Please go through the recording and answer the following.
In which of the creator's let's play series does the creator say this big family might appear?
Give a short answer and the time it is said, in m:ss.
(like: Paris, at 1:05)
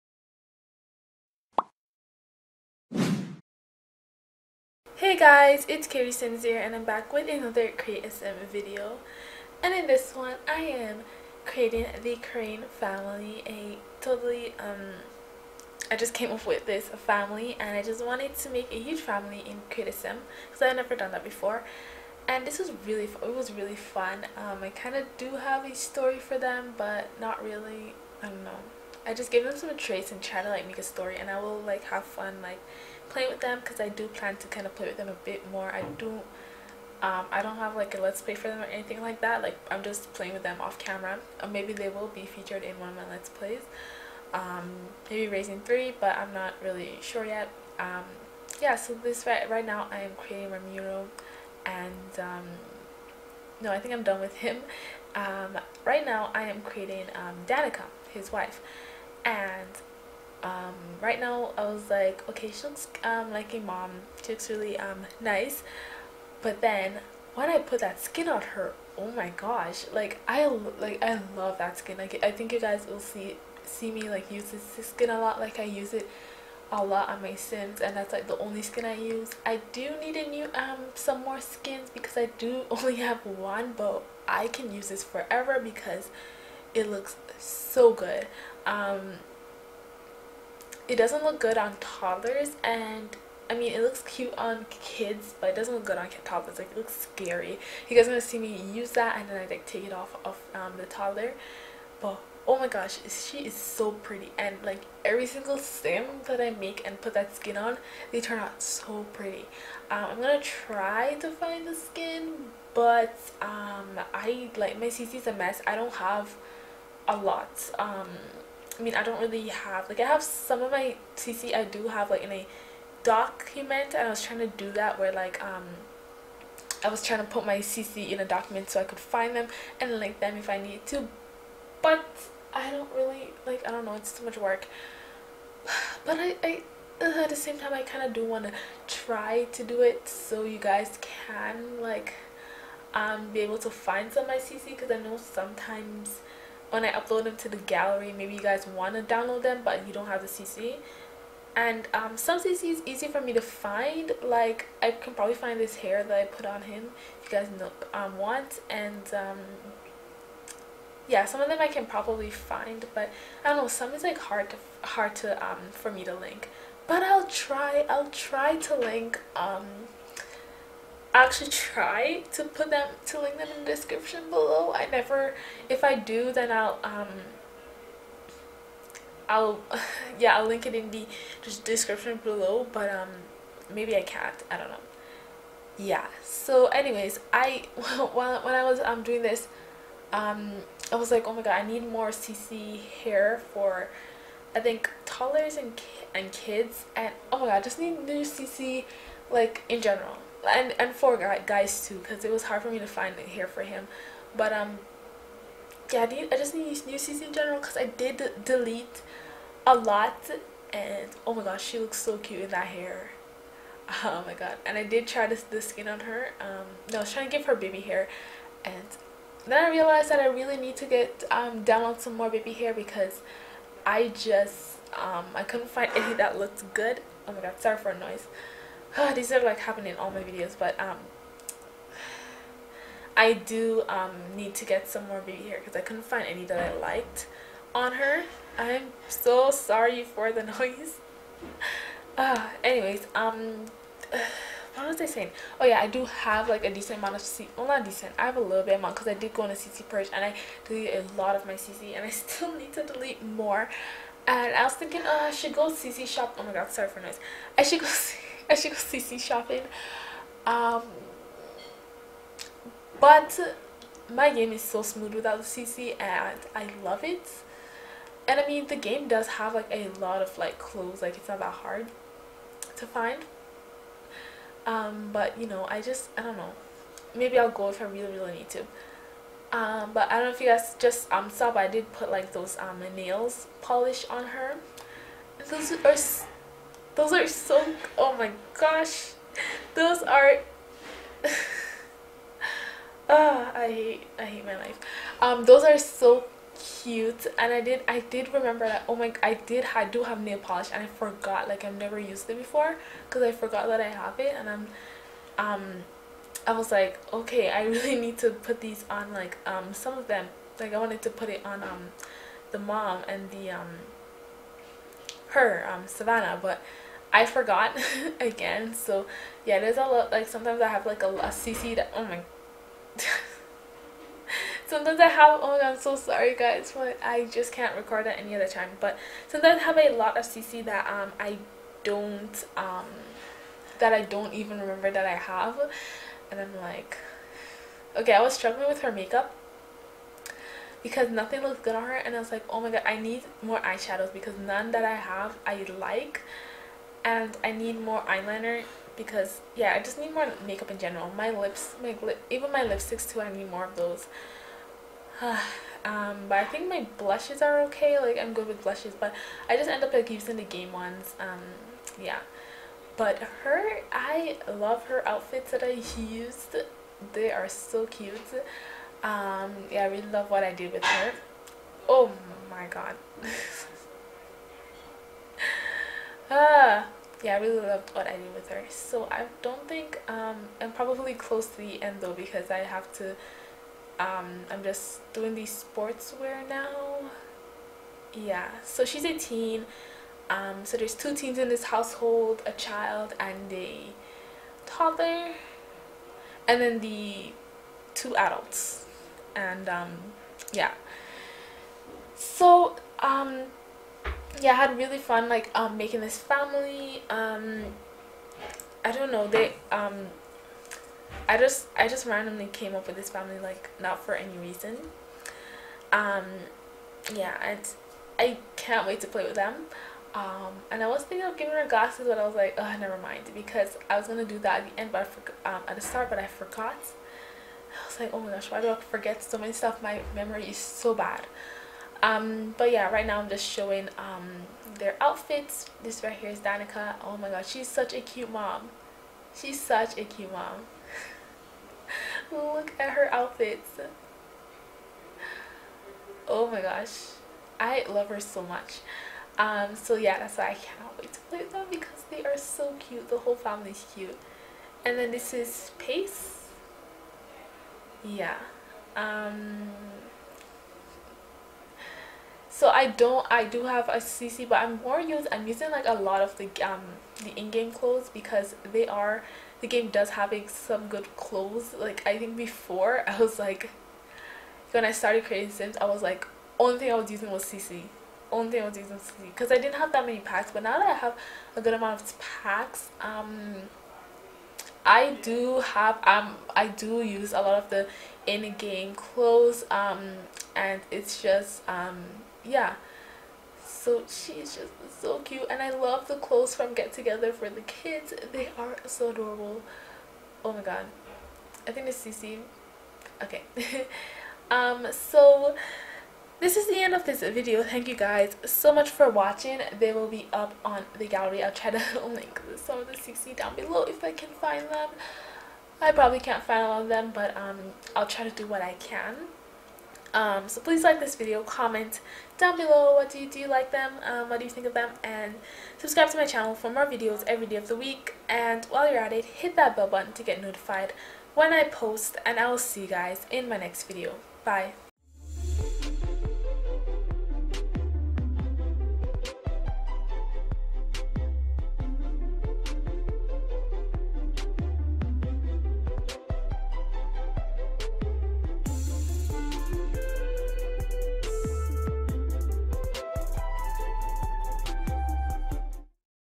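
Raising 3, at 0:45.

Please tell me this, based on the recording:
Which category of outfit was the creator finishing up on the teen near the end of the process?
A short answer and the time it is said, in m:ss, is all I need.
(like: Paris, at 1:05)
Sportswear, at 6:25.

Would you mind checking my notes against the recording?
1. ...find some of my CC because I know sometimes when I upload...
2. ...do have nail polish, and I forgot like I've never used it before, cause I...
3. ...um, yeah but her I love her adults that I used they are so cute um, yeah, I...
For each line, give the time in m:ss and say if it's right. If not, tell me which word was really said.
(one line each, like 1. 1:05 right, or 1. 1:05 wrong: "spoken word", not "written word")
1. 2:23 right
2. 4:59 right
3. 6:01 wrong: "outfits", not "adults".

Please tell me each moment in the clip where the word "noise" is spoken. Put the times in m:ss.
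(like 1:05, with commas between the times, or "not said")
3:47, 4:00, 4:16.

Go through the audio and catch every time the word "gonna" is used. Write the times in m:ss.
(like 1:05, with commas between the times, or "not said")
1:38, 1:50, 7:04.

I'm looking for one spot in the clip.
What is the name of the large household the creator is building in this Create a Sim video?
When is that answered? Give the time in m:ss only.
0:12.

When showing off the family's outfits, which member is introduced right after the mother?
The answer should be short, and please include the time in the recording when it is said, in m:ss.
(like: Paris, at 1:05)
Pace, at 7:35.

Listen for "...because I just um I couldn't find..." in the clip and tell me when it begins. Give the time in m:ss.
3:42.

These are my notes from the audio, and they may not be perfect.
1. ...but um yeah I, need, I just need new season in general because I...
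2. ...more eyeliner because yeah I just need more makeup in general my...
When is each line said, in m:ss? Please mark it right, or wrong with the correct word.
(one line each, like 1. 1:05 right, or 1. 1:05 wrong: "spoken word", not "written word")
1. 3:24 right
2. 5:47 right.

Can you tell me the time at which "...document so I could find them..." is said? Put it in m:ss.
2:08.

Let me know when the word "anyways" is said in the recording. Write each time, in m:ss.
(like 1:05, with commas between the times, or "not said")
3:06, 4:02.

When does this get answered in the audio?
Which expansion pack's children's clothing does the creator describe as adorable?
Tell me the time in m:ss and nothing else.
8:16.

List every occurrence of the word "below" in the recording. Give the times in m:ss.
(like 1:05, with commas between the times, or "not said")
2:54, 3:02, 8:33, 8:42.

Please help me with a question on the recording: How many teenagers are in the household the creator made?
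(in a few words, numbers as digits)
2.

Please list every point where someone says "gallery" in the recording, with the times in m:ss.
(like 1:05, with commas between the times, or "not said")
2:27, 8:31.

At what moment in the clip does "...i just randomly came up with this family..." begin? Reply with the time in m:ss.
6:51.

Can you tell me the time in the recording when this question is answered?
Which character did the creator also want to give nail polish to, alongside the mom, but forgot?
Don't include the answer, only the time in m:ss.
5:15.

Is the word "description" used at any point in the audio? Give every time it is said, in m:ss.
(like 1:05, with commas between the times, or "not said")
2:53, 3:01.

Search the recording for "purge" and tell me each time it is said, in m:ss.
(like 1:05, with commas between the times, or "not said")
4:09.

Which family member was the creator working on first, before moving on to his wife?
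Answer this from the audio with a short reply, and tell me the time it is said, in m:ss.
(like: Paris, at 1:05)
Ramiro, at 0:50.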